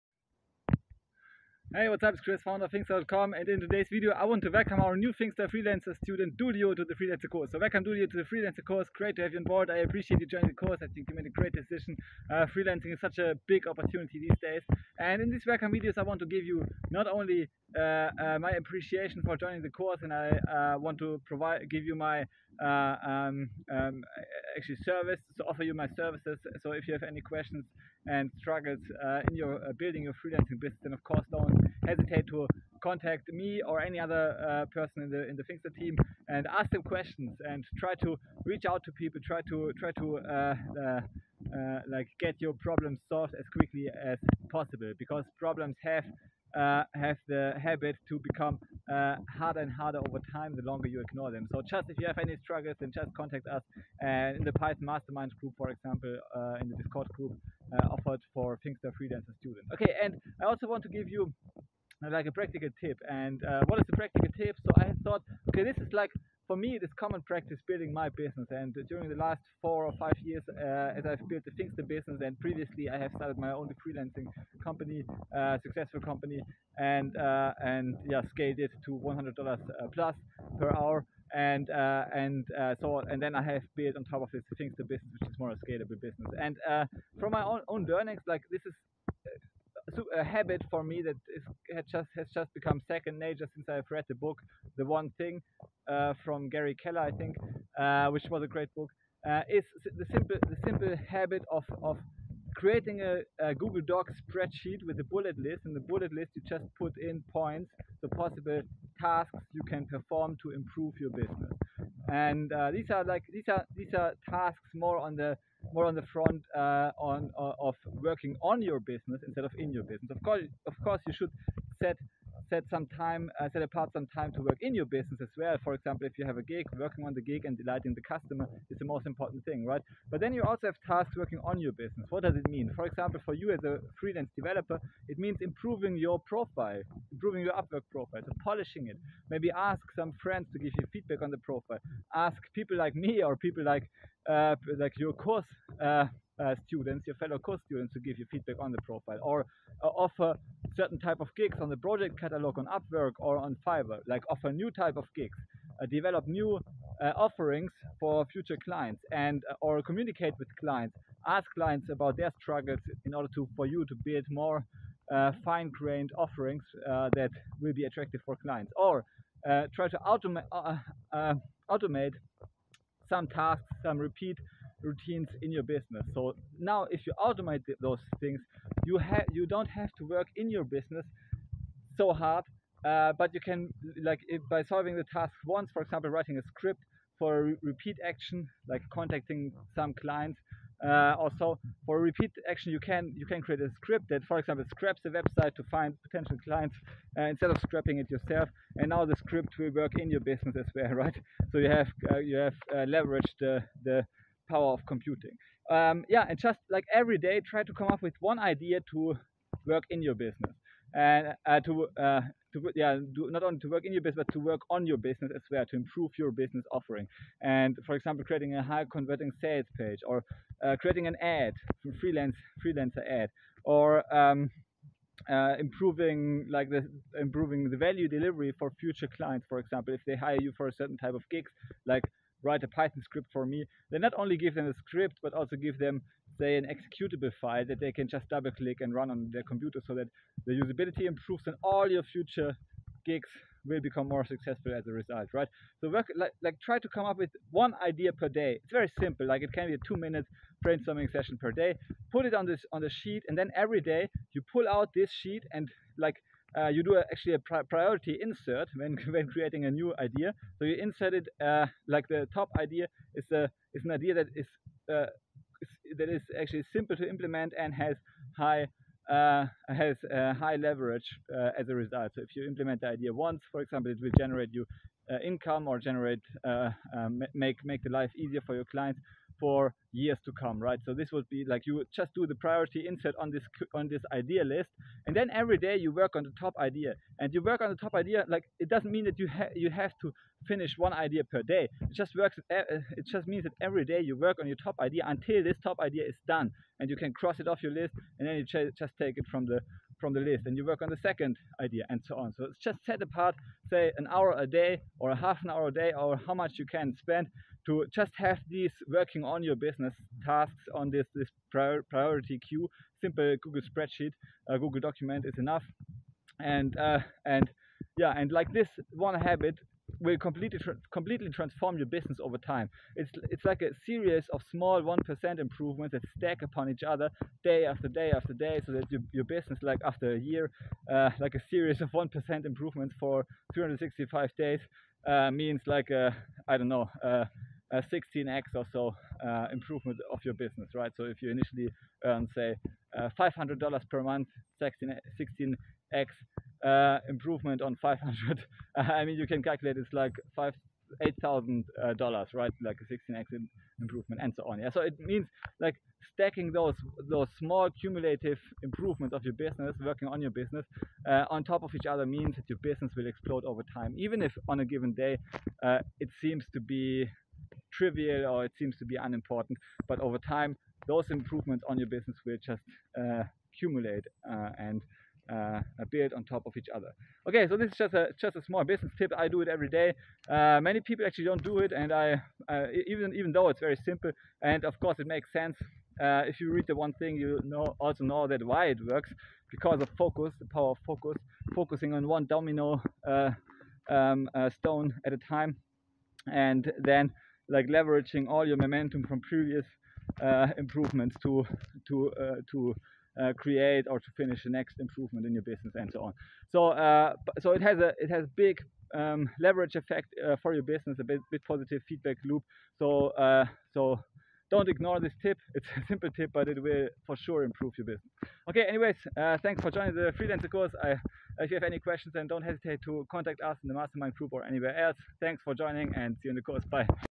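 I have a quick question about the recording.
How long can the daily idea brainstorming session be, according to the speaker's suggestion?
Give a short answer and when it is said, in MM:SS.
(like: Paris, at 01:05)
2 minutes, at 04:09.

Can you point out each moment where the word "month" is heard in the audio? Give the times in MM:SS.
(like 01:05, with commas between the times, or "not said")
05:44.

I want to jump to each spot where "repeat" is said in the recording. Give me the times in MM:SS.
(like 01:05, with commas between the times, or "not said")
02:53, 03:07, 03:11.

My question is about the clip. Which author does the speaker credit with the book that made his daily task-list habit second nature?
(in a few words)
Gary Keller.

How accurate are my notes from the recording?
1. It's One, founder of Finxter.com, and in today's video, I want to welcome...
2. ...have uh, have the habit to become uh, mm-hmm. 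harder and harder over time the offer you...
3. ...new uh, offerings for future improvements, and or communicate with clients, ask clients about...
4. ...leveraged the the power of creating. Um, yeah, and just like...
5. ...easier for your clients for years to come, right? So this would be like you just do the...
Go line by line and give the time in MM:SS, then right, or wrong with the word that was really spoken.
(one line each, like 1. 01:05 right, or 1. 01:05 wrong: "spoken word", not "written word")
1. 00:02 wrong: "Chris", not "One"
2. 00:45 wrong: "longer", not "offer"
3. 02:36 wrong: "clients", not "improvements"
4. 03:22 wrong: "computing", not "creating"
5. 04:38 right.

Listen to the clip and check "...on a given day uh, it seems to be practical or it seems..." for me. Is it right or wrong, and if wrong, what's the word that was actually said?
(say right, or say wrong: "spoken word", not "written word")
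wrong: "trivial", not "practical".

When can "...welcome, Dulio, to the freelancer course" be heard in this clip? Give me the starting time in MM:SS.
00:07.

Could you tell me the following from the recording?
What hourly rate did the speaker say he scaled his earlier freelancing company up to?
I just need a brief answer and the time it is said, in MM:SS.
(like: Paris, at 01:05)
$100 plus per hour, at 01:18.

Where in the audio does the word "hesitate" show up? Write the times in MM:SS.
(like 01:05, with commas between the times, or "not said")
00:31, 07:02.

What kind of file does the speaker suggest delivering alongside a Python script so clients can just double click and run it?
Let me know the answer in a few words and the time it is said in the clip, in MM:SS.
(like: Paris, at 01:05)
An executable file, at 03:56.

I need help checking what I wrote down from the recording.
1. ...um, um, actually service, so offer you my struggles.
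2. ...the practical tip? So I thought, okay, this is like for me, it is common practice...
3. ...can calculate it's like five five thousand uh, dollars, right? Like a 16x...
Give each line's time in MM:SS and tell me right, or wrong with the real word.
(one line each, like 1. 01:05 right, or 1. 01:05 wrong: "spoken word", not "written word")
1. 00:23 wrong: "services", not "struggles"
2. 01:03 right
3. 05:49 wrong: "eight", not "five".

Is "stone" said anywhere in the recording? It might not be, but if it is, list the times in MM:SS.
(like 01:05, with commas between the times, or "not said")
06:34.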